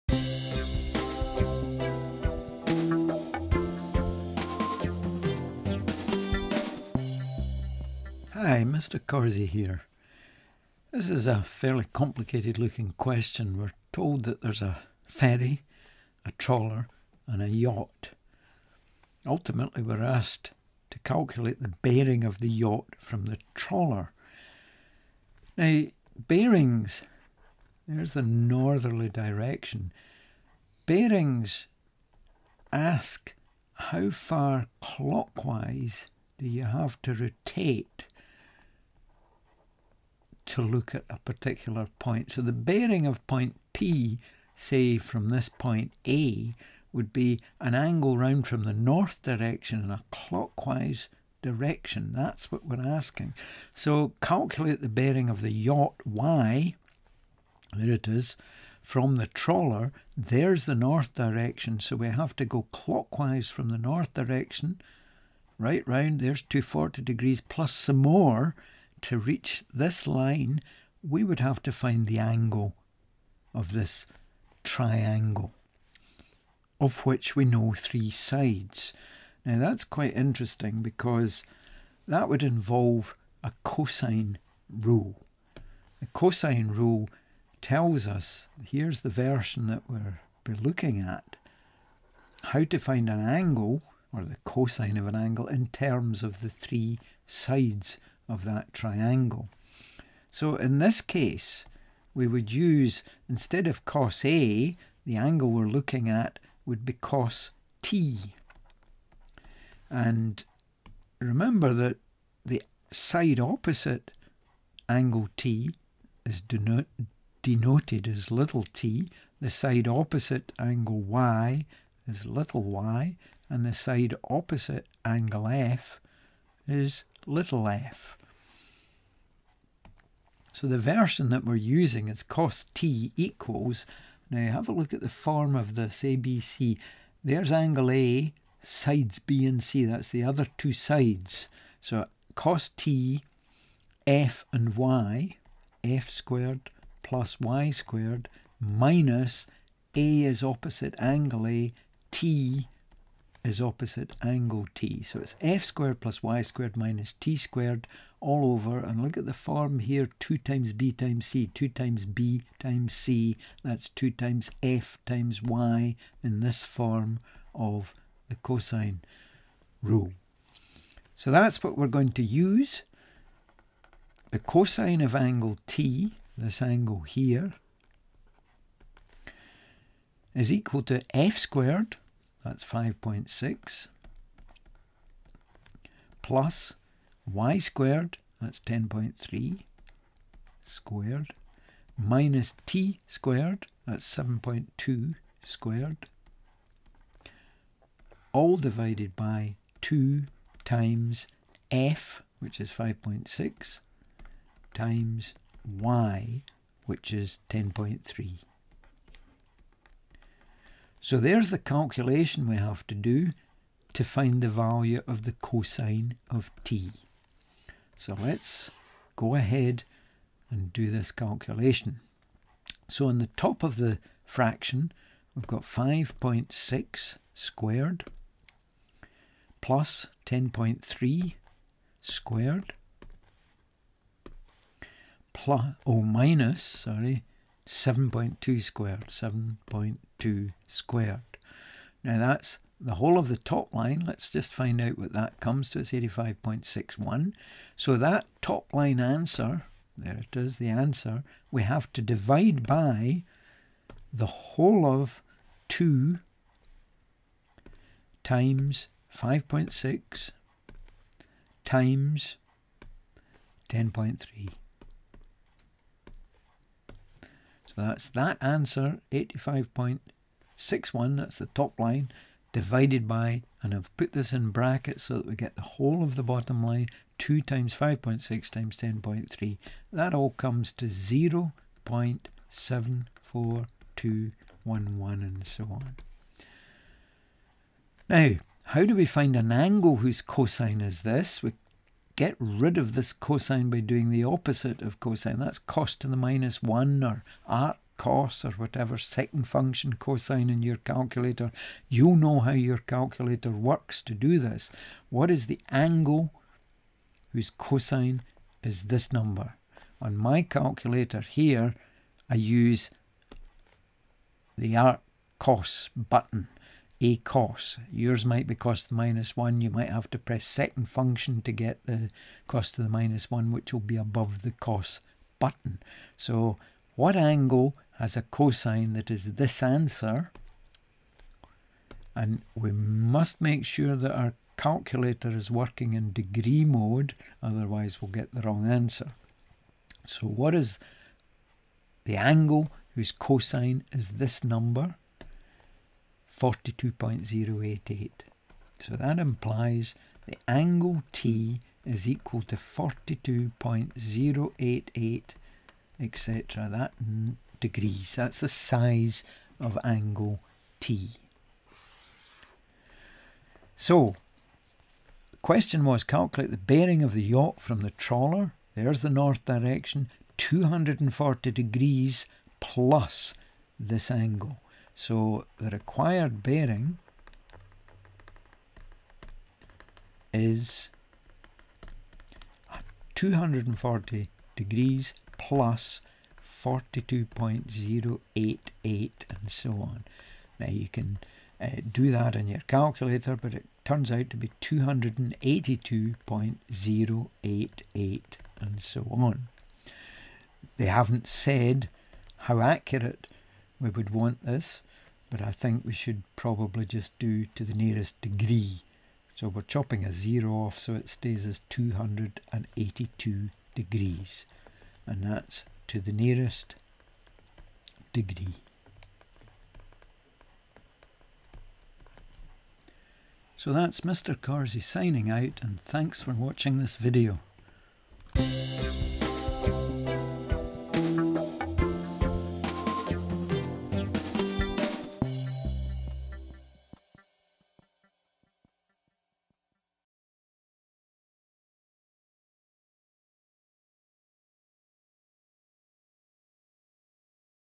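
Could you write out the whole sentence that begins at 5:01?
you know how your calculator works to do this.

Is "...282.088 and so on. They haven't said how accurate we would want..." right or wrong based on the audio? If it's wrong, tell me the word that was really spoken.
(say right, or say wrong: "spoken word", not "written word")
right.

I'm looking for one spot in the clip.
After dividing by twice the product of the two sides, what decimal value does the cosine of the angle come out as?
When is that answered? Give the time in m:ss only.
4:40.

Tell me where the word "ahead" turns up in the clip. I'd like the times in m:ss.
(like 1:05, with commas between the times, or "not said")
3:39.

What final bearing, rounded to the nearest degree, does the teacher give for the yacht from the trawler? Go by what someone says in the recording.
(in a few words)
282 degrees.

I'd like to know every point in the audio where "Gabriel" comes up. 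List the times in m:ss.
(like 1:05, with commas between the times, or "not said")
not said.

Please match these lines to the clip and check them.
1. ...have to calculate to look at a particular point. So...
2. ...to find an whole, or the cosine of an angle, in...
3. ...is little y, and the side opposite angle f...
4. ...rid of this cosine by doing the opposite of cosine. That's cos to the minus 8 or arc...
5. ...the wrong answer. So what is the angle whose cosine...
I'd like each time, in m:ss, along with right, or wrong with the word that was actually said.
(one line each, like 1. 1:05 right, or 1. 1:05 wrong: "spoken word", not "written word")
1. 0:36 wrong: "rotate", not "calculate"
2. 1:32 wrong: "angle", not "whole"
3. 2:02 right
4. 4:52 wrong: "1", not "8"
5. 5:38 right.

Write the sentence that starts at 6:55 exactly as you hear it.
And that's to the nearest degree.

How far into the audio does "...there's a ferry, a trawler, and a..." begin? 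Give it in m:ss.
0:14.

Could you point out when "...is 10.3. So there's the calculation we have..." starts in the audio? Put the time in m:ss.
3:27.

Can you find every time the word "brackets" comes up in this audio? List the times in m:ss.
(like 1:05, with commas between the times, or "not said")
4:34.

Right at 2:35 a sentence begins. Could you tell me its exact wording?
So it's f squared plus y squared minus t squared all over.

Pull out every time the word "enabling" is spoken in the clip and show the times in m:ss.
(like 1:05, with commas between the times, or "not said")
not said.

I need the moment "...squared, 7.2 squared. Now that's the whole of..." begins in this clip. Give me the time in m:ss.
3:58.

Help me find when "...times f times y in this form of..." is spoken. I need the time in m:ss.
2:44.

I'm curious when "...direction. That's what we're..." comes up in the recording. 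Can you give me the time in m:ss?
0:51.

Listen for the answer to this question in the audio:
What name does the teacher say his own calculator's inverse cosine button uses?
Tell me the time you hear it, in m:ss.
5:17.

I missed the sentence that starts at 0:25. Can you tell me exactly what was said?
Now, bearings, there's the northerly direction.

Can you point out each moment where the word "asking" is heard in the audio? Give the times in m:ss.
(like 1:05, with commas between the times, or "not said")
0:52.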